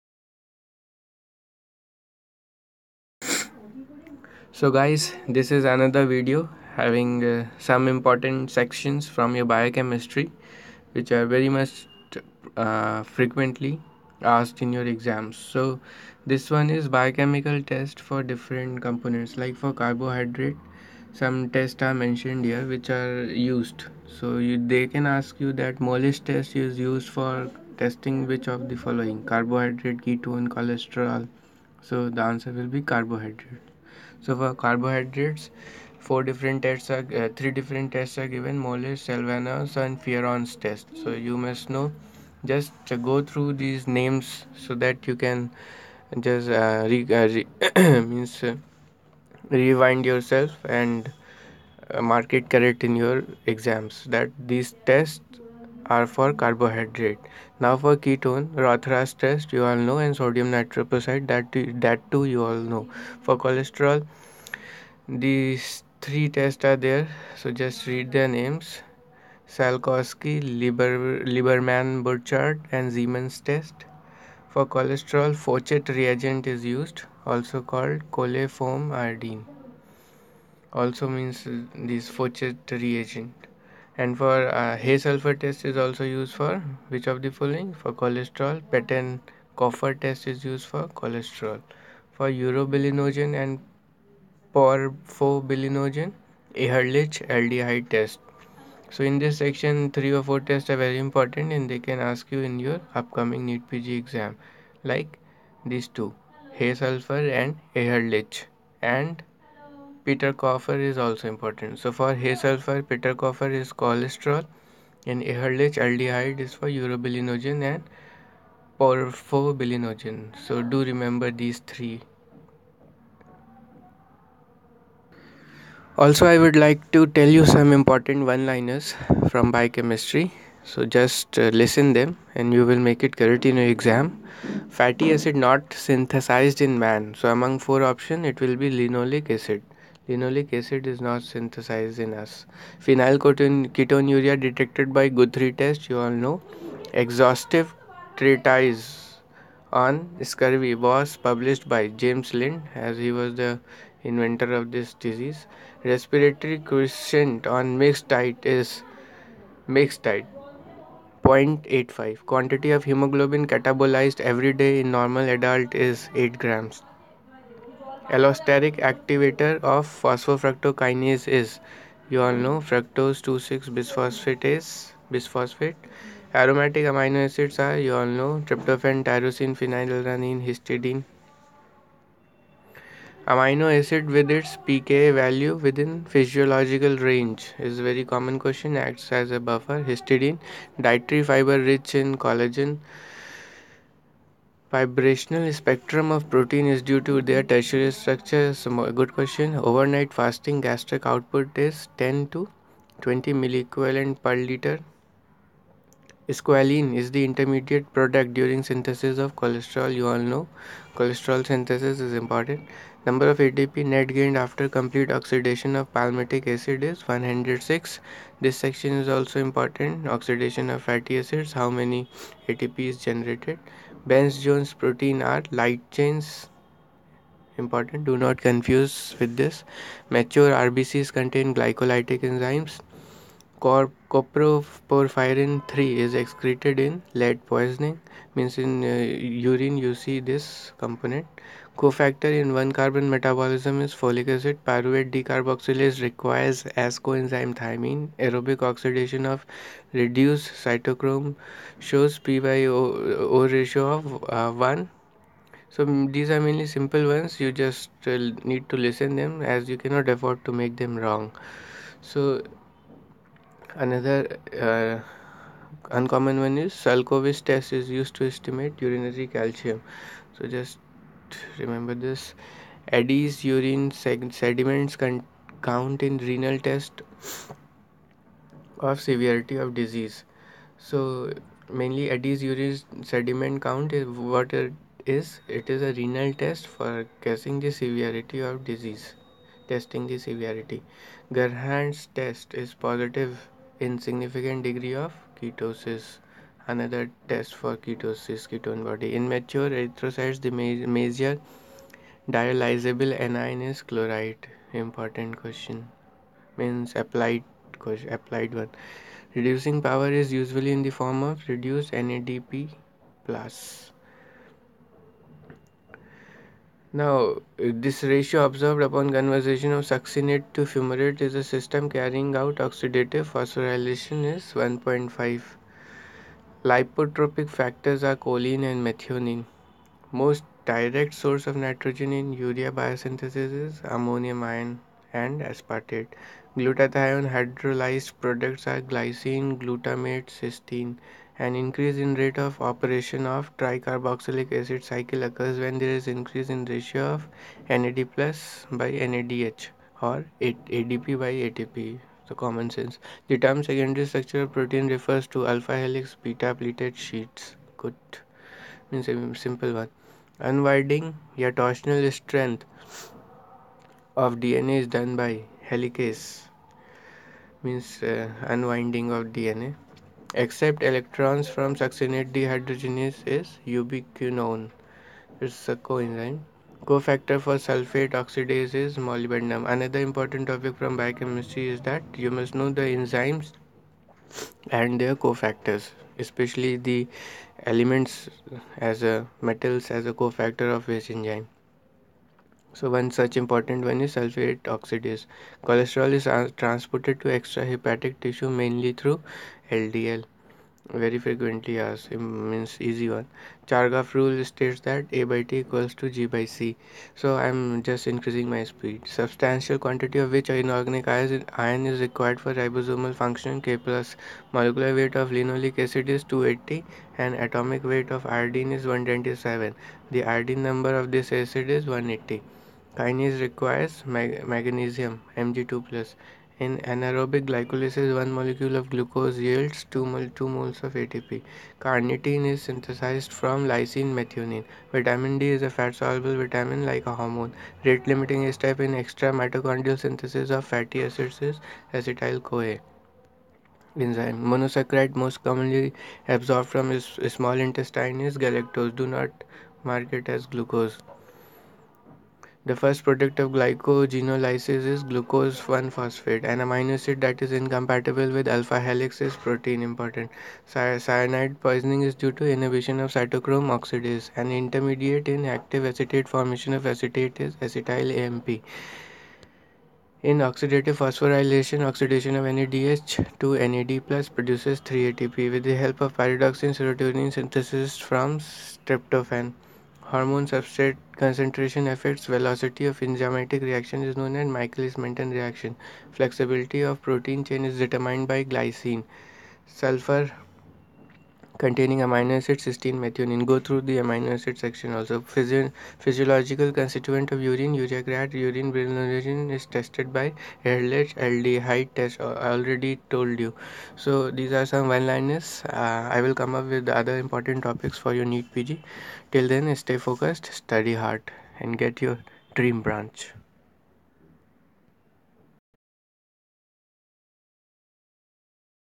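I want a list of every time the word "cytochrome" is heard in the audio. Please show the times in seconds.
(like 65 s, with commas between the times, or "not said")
250 s, 463 s.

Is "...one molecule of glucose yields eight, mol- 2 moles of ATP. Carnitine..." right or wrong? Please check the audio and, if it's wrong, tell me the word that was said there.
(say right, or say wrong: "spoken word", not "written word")
wrong: "two", not "eight".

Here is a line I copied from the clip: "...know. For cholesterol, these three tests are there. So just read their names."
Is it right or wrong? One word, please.
right.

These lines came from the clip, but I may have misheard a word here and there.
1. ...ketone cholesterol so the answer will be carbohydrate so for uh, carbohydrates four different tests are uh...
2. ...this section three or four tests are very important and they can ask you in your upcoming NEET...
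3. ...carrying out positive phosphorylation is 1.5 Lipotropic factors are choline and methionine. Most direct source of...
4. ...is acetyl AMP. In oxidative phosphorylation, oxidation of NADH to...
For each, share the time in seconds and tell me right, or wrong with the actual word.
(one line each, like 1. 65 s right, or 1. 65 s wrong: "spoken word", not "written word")
1. 30 s right
2. 99 s right
3. 321 s wrong: "oxidative", not "positive"
4. 467 s right.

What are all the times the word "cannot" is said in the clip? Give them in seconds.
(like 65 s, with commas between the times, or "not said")
259 s.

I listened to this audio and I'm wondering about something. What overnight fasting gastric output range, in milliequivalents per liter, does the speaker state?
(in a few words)
10 to 20.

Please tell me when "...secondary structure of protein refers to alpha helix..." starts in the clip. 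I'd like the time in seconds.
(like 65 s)
353 s.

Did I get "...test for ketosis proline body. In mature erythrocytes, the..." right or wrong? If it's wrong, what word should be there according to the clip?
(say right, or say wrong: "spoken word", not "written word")
wrong: "ketone", not "proline".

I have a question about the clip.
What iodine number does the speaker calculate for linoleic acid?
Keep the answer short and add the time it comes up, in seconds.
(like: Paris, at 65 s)
180, at 421 s.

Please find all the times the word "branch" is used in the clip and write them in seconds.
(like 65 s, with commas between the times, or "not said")
512 s.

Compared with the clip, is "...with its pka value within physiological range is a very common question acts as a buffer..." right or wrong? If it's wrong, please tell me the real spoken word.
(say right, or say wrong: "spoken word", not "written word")
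right.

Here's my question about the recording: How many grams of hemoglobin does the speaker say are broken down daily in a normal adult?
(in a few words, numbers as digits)
8 grams.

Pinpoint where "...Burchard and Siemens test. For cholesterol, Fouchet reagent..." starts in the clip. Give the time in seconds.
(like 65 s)
72 s.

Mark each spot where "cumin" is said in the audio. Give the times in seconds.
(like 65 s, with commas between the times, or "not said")
not said.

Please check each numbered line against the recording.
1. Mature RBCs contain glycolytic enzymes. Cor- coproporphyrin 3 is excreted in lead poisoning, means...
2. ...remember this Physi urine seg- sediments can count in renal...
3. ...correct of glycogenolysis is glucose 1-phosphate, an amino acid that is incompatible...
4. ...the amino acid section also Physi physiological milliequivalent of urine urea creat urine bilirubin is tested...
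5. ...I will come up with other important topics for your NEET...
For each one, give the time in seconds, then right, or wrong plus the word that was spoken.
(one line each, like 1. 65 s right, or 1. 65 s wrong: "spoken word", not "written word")
1. 230 s right
2. 271 s wrong: "Addis", not "Physi"
3. 453 s wrong: "product", not "correct"
4. 493 s wrong: "constituent", not "milliequivalent"
5. 506 s right.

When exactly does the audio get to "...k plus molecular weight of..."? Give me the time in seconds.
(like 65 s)
413 s.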